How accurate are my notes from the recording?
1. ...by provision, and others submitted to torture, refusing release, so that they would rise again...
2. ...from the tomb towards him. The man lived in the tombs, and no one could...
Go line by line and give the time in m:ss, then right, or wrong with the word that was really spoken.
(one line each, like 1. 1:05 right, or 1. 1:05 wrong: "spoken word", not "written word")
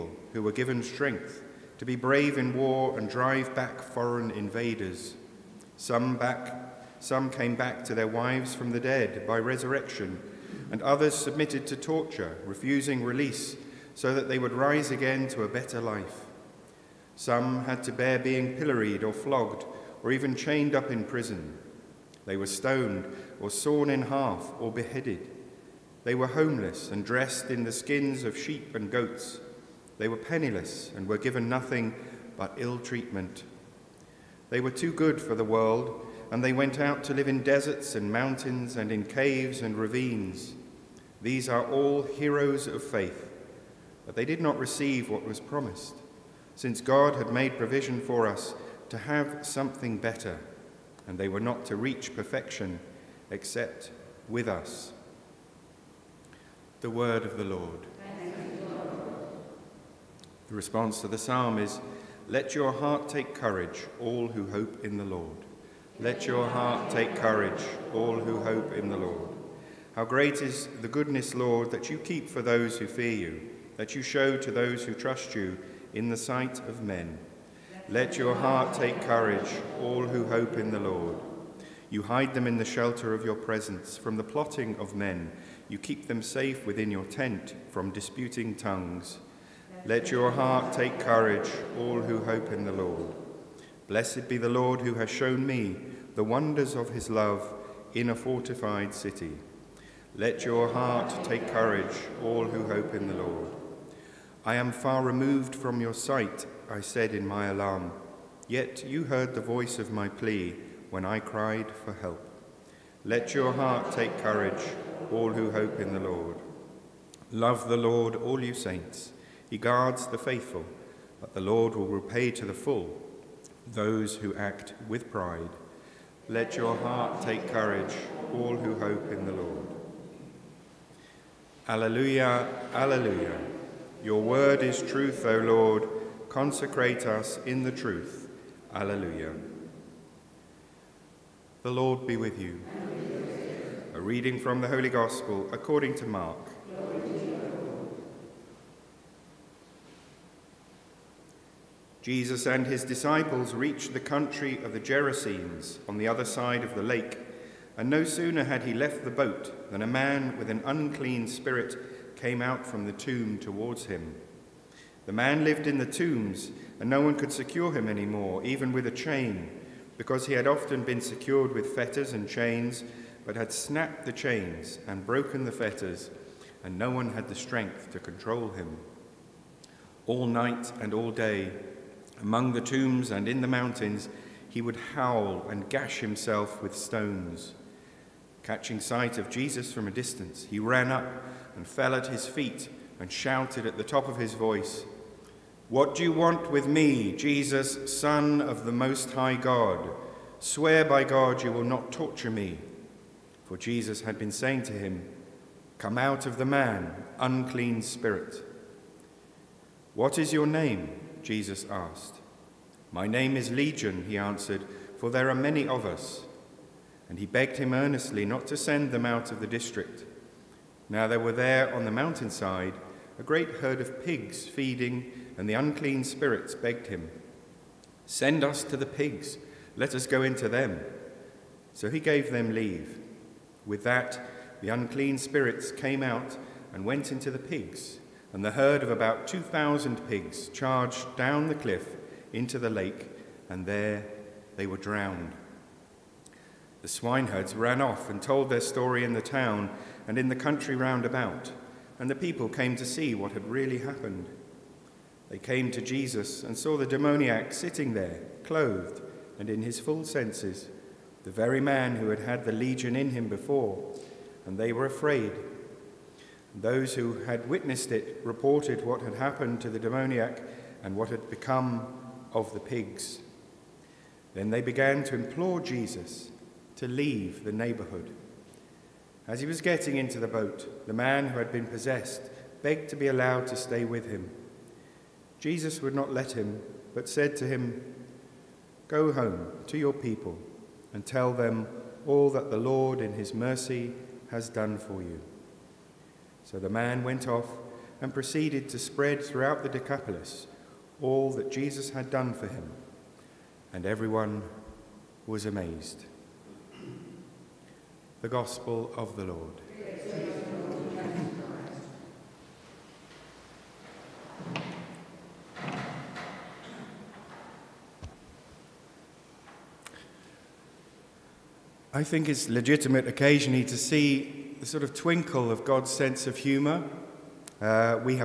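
1. 0:09 wrong: "resurrection", not "provision"
2. 2:42 right.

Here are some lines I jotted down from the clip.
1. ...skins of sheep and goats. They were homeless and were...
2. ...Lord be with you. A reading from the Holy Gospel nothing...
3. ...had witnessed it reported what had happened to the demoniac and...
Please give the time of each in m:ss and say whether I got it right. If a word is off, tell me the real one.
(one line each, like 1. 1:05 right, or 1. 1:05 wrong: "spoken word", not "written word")
1. 0:27 wrong: "penniless", not "homeless"
2. 2:21 wrong: "according", not "nothing"
3. 4:27 right.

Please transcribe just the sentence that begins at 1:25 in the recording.
You keep them safe within your tent from disputing tongues.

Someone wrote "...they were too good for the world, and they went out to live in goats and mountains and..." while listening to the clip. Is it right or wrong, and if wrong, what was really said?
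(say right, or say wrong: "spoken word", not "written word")
wrong: "deserts", not "goats".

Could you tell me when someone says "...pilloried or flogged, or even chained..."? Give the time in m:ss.
0:18.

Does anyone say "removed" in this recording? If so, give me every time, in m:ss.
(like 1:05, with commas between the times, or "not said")
1:45.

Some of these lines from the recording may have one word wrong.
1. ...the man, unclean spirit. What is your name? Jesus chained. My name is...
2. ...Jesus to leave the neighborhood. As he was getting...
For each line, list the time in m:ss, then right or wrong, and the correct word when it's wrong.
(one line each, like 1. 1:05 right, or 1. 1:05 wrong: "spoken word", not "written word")
1. 3:26 wrong: "asked", not "chained"
2. 4:35 right.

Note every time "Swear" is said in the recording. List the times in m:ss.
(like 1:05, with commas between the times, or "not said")
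3:20.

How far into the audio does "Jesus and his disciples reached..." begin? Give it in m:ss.
2:32.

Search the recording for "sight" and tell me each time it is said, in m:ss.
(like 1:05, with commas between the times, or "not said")
1:16, 1:45, 3:08.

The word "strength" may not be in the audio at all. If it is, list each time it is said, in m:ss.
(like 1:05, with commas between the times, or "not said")
0:00, 2:57.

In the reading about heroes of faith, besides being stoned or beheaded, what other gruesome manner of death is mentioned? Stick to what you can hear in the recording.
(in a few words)
Sawn in half.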